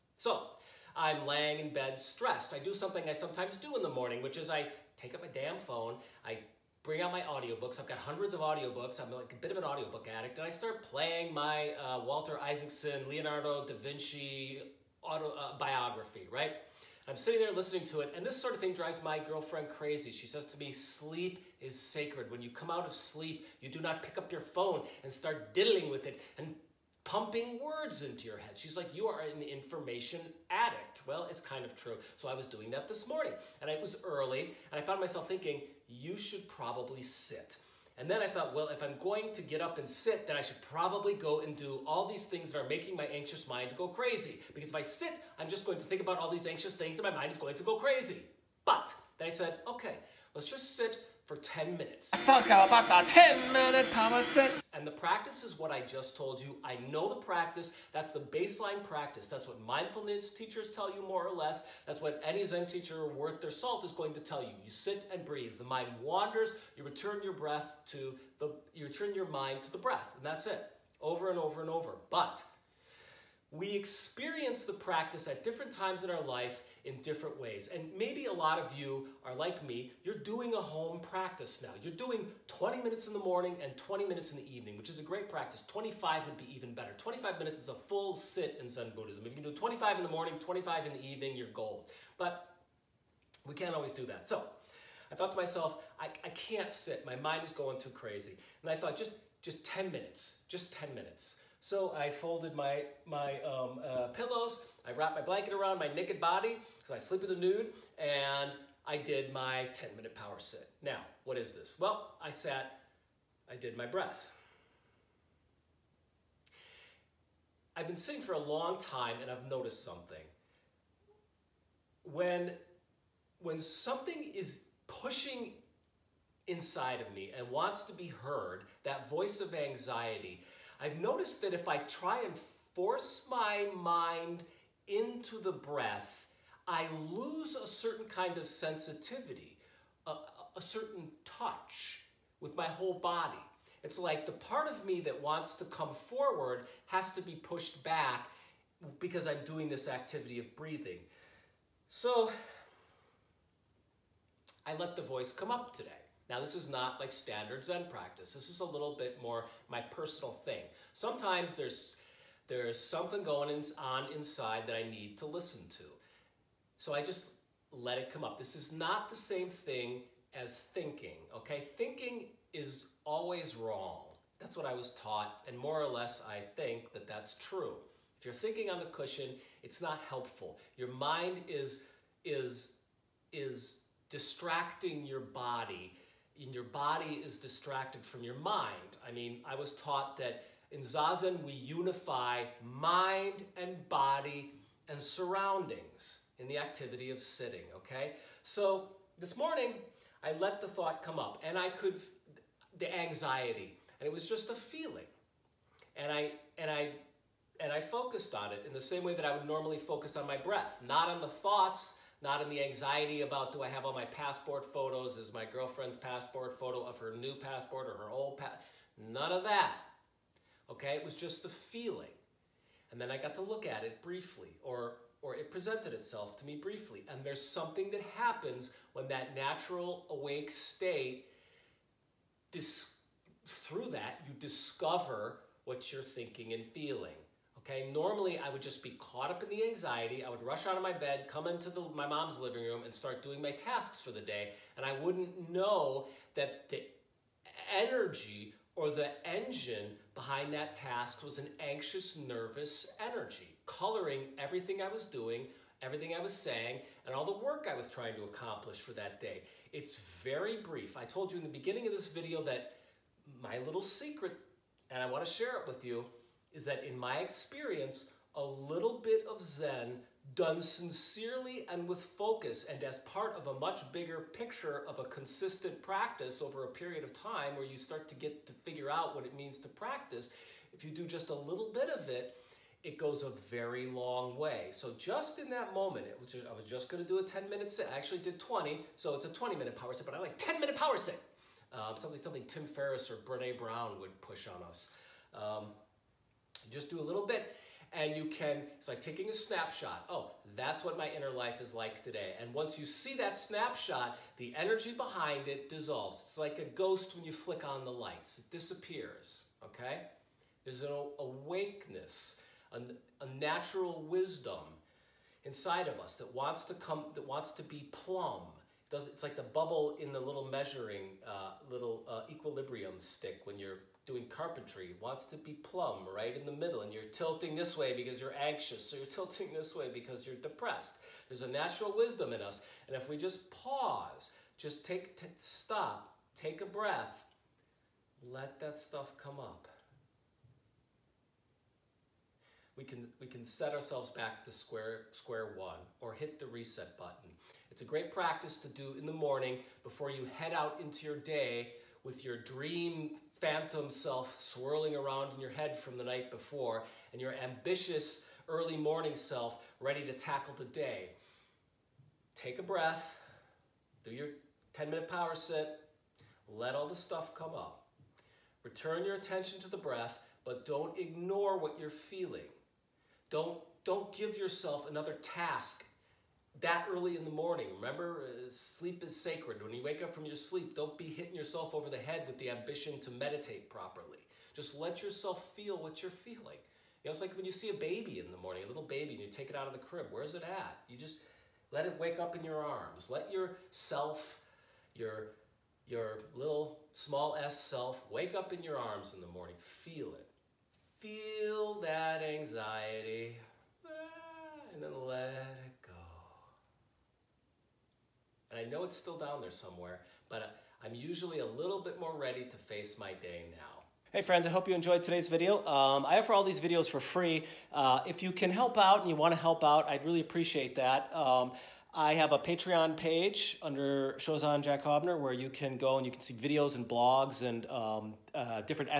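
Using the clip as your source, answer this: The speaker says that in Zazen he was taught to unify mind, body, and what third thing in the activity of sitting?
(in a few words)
surroundings.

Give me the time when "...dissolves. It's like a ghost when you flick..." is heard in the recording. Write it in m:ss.
5:05.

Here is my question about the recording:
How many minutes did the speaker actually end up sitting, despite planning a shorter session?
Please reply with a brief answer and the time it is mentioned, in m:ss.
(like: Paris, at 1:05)
20, at 4:47.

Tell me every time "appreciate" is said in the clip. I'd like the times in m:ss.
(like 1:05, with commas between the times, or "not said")
7:00.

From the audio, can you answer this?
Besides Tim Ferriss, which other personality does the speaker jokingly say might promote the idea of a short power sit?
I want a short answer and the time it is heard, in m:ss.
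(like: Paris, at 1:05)
Brene Brown, at 4:53.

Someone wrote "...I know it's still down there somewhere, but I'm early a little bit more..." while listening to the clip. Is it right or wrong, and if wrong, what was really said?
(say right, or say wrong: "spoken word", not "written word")
wrong: "usually", not "early".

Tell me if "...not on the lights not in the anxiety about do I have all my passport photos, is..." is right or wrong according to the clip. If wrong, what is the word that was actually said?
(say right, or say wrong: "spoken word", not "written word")
wrong: "thoughts", not "lights".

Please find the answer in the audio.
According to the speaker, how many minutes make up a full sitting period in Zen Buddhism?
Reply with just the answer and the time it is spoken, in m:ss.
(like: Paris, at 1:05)
25, at 1:26.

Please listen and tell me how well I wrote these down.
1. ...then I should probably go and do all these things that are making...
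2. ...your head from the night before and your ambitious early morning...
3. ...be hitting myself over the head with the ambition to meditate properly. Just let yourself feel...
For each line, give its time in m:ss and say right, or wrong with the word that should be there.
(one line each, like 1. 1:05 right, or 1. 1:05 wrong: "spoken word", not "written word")
1. 0:40 right
2. 5:55 right
3. 6:20 wrong: "yourself", not "myself".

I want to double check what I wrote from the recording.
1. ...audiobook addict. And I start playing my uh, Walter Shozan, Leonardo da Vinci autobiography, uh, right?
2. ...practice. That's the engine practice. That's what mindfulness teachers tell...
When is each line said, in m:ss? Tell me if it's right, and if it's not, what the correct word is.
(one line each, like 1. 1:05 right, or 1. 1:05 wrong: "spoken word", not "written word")
1. 0:09 wrong: "Isaacson", not "Shozan"
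2. 0:57 wrong: "baseline", not "engine".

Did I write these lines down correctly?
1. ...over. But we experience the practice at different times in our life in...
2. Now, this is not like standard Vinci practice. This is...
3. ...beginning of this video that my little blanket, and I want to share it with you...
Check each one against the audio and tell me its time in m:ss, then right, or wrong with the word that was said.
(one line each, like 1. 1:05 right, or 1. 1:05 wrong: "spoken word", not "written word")
1. 1:11 right
2. 2:36 wrong: "Zen", not "Vinci"
3. 4:21 wrong: "secret", not "blanket".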